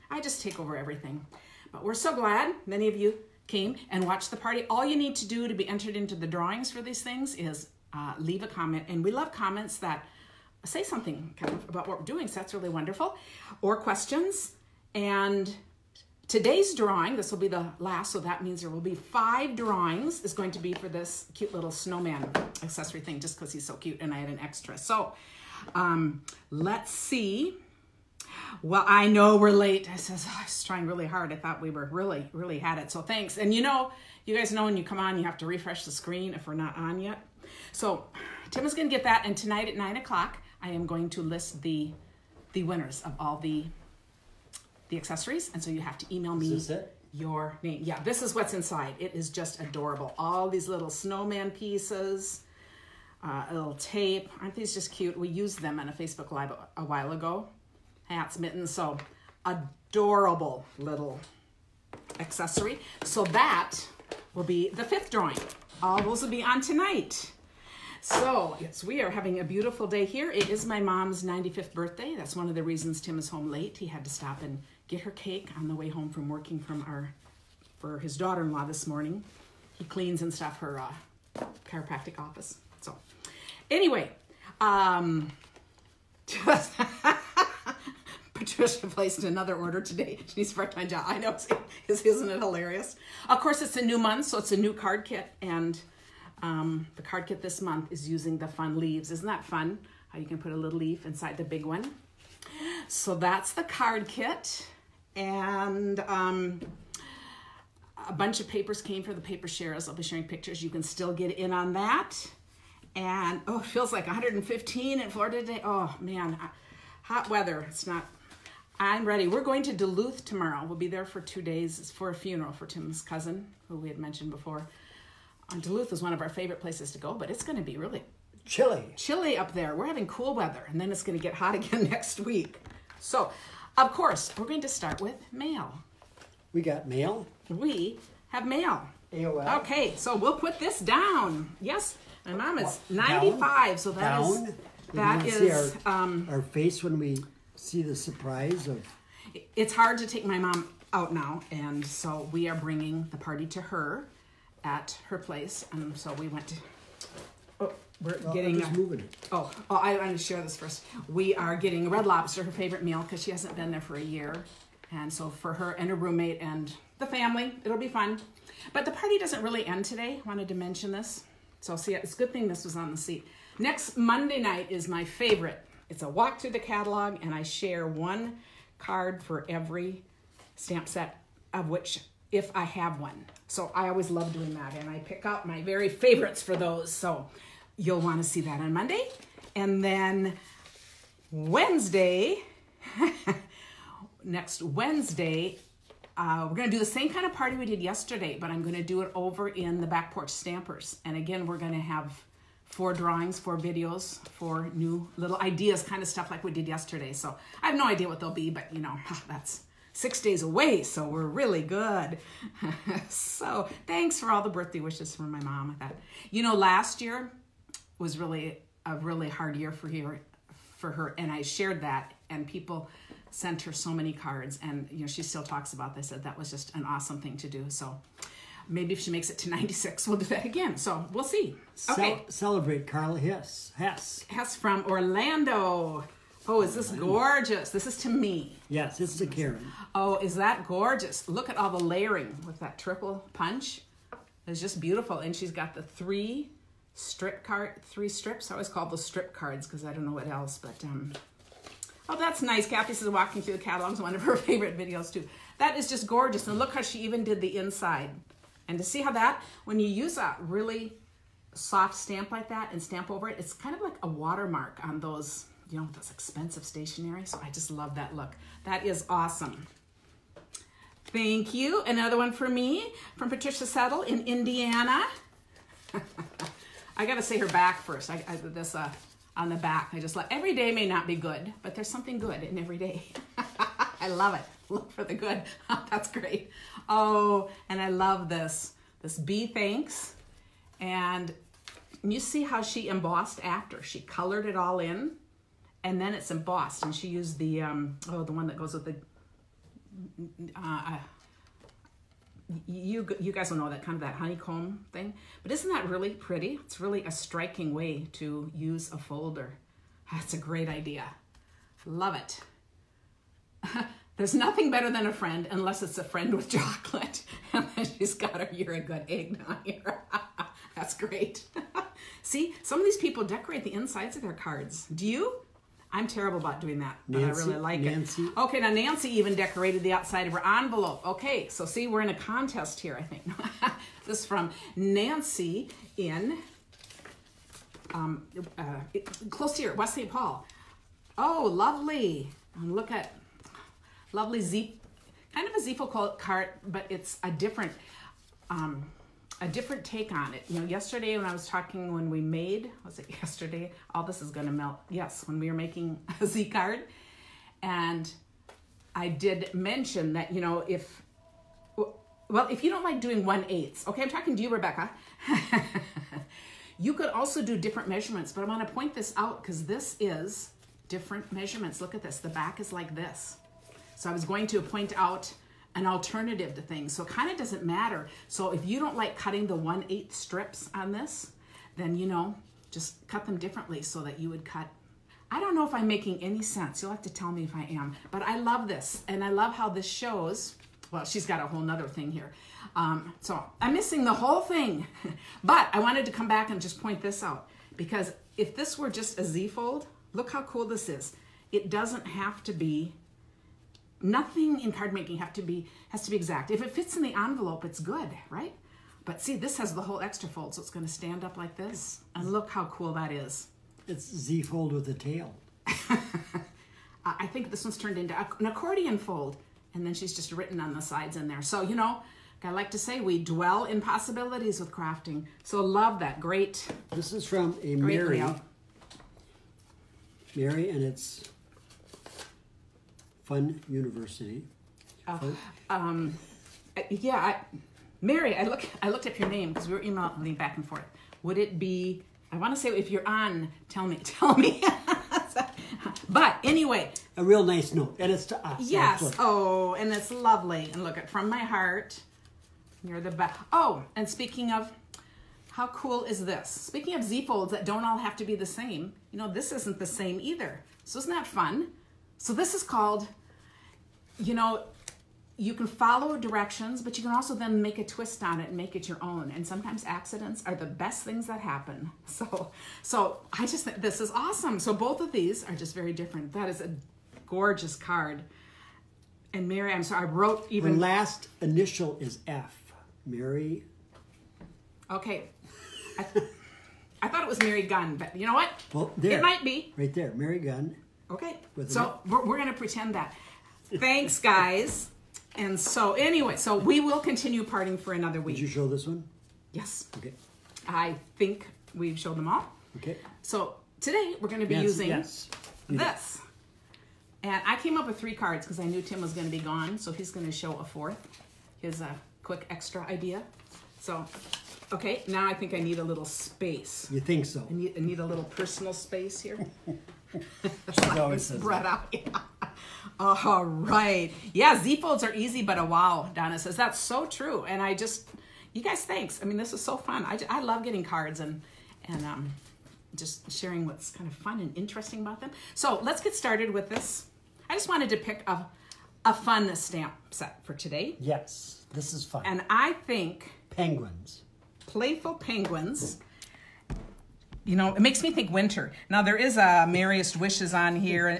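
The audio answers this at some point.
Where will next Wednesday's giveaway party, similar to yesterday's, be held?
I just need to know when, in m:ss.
3:19.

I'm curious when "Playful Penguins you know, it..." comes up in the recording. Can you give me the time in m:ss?
9:04.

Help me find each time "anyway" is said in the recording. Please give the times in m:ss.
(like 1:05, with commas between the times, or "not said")
1:23, 7:26, 8:15.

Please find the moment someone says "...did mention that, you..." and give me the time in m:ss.
5:59.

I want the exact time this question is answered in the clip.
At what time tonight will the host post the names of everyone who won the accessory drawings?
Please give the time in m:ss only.
0:39.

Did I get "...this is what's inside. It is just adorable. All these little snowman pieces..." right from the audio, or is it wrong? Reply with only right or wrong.
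right.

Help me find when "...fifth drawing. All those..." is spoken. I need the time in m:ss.
1:04.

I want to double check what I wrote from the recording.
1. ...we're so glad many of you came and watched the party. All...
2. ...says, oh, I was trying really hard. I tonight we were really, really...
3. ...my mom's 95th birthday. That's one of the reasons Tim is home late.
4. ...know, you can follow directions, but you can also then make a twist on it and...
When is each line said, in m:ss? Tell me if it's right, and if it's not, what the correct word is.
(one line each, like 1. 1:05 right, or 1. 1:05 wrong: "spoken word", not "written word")
1. 0:01 right
2. 0:29 wrong: "thought", not "tonight"
3. 1:10 right
4. 7:44 right.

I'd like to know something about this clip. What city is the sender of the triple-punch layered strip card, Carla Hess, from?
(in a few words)
Orlando.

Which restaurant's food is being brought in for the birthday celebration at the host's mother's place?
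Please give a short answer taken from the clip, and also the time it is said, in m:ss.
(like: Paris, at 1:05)
Red Lobster, at 2:41.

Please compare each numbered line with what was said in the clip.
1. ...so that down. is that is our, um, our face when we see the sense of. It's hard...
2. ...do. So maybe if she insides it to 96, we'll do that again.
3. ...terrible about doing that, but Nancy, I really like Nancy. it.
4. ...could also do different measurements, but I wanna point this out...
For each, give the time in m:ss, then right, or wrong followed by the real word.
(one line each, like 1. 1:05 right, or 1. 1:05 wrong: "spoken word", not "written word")
1. 2:23 wrong: "surprise", not "sense"
2. 3:47 wrong: "makes", not "insides"
3. 5:26 right
4. 6:06 right.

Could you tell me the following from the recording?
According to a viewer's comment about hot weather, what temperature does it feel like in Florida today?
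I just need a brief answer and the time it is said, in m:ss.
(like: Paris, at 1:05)
115, at 1:54.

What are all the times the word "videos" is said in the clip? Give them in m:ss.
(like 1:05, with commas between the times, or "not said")
3:23, 4:14.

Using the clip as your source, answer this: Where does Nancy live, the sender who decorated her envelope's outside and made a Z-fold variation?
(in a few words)
West St. Paul.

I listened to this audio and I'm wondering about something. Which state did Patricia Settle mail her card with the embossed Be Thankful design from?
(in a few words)
Indiana.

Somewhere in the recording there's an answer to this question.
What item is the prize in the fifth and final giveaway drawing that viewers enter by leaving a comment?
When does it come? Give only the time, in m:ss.
0:21.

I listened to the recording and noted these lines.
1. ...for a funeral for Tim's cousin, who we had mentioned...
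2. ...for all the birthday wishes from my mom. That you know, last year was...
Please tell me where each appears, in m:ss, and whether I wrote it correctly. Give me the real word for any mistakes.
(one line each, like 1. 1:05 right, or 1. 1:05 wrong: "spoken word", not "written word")
1. 2:01 right
2. 3:34 right.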